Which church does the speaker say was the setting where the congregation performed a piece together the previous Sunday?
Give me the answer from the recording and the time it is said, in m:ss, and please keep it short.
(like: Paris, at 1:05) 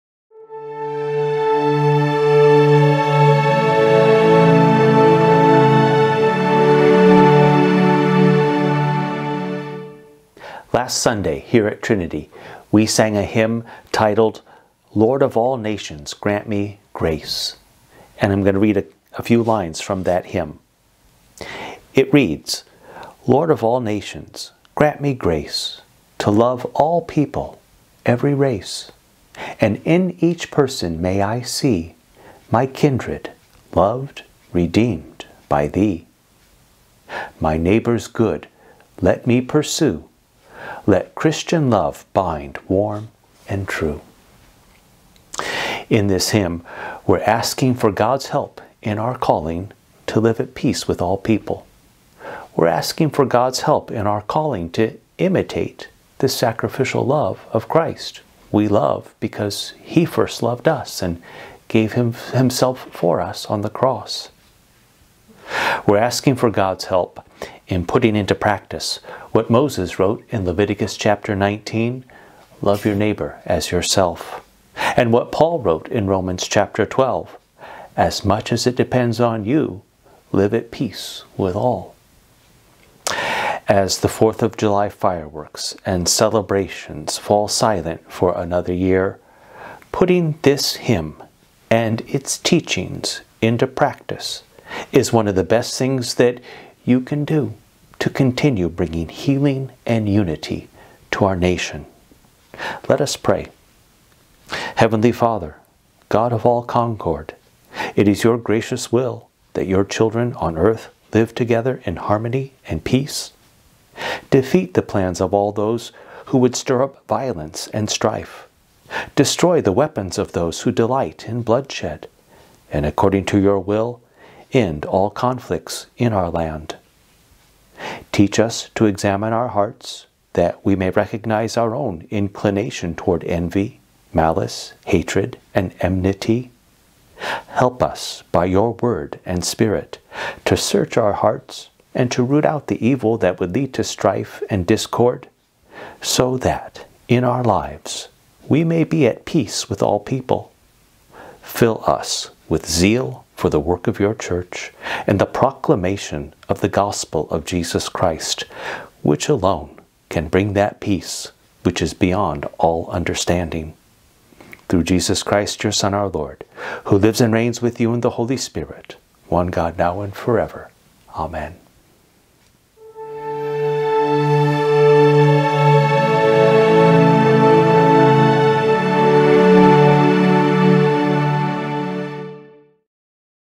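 Trinity, at 0:11.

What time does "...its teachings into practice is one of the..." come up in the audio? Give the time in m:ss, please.
1:32.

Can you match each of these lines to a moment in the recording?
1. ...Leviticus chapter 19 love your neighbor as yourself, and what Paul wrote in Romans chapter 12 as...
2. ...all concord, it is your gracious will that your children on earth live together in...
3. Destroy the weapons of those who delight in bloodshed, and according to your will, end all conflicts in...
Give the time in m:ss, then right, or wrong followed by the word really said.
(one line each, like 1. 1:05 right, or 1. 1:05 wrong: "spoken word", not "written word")
1. 1:10 right
2. 1:46 right
3. 1:59 right.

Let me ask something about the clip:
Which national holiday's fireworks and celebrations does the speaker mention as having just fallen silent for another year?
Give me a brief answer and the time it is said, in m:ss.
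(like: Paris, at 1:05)
4th of July, at 1:24.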